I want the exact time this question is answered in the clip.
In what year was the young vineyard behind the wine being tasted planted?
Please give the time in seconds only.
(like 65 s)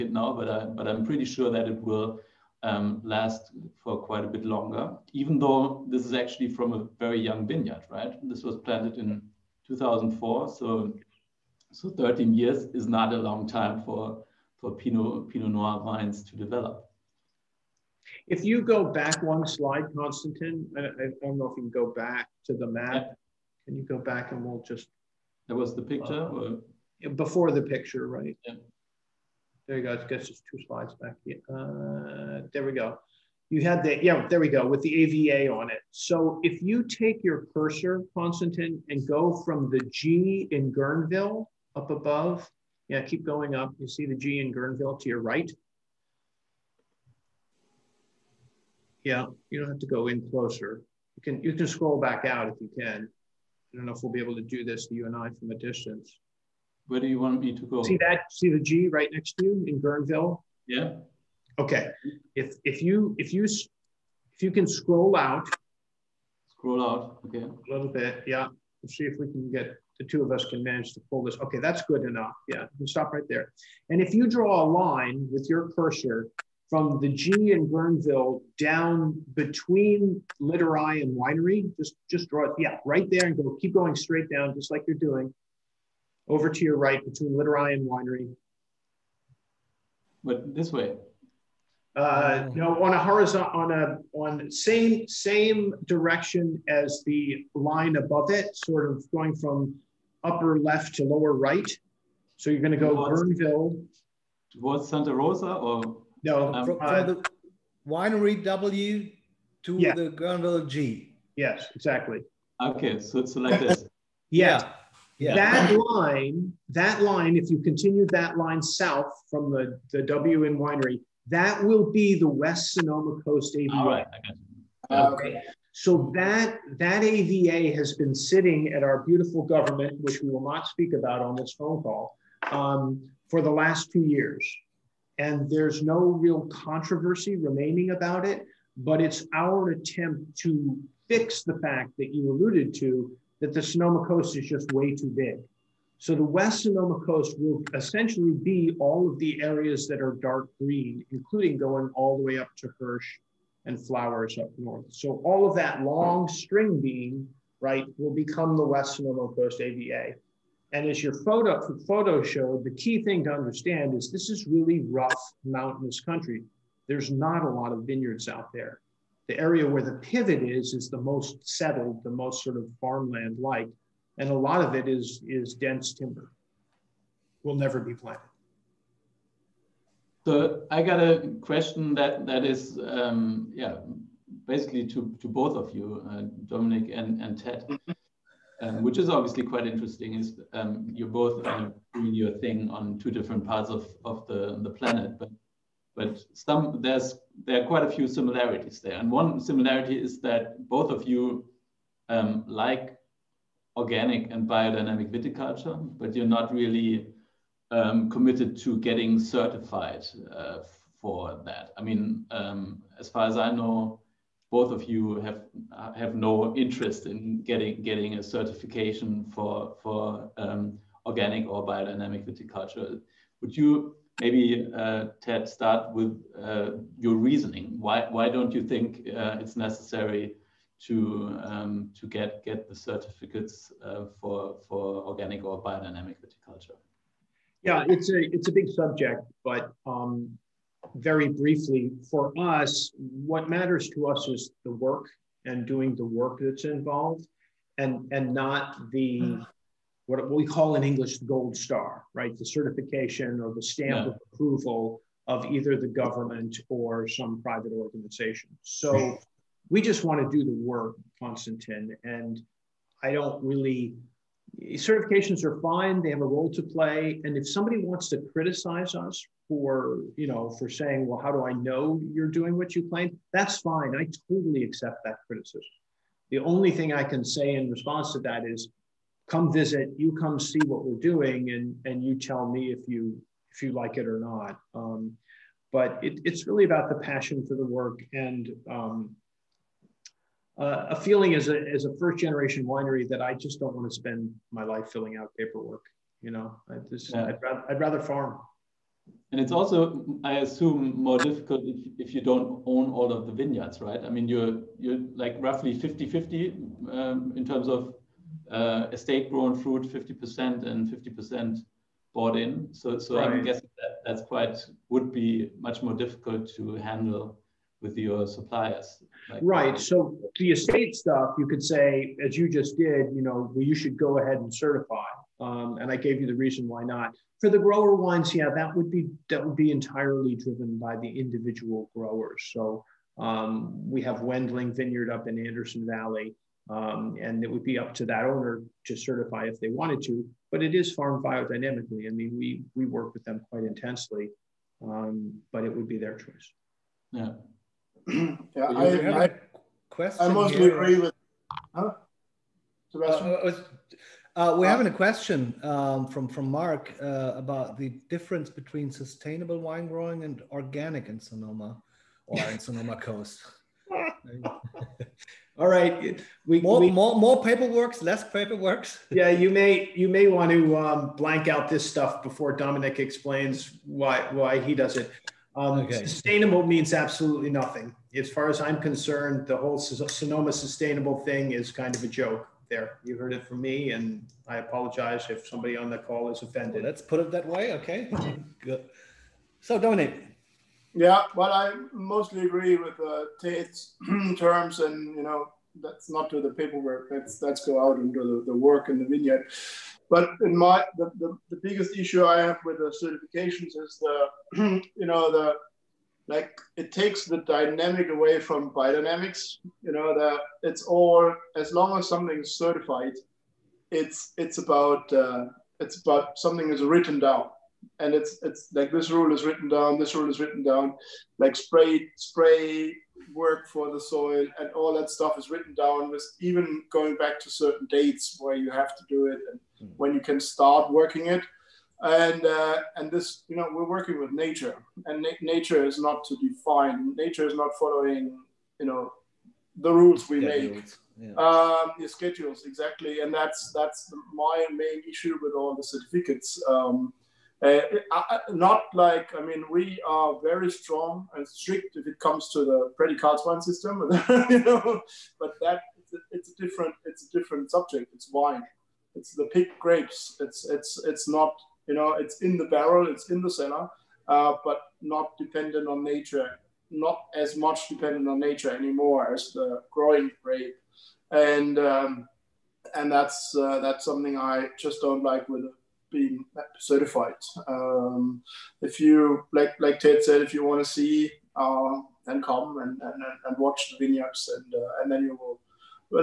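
9 s.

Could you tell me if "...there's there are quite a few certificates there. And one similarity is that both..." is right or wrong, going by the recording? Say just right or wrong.
wrong.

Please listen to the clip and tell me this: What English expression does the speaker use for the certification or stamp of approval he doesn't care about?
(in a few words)
gold star.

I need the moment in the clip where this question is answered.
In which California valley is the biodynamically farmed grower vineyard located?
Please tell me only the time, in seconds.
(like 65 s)
335 s.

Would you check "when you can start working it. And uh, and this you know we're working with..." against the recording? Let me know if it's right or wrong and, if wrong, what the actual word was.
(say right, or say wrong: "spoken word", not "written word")
right.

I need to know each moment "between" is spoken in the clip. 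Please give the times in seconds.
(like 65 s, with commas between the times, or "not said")
79 s, 87 s, 358 s.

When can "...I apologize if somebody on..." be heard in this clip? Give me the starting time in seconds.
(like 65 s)
384 s.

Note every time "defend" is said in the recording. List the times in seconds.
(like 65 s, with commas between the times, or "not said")
not said.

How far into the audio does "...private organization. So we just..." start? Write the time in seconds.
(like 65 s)
257 s.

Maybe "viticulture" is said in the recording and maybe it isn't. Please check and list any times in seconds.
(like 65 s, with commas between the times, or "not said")
205 s, 222 s, 236 s.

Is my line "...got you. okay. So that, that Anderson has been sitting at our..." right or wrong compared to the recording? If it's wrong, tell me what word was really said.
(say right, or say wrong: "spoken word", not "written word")
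wrong: "AVA", not "Anderson".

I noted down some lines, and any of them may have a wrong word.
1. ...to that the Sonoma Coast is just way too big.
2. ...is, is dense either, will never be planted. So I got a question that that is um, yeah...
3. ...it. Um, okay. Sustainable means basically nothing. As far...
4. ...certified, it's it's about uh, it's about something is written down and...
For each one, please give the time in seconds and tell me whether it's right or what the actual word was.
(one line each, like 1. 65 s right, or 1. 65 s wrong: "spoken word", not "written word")
1. 142 s right
2. 174 s wrong: "timber", not "either"
3. 374 s wrong: "absolutely", not "basically"
4. 412 s right.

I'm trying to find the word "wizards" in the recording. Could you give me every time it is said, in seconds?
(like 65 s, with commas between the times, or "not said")
not said.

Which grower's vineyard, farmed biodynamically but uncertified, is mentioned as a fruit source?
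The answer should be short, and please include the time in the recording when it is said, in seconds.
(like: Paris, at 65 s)
Wendling Vineyard, at 334 s.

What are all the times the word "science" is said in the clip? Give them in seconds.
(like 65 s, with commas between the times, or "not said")
not said.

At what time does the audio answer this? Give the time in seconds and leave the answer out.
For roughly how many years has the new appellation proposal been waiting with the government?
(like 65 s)
133 s.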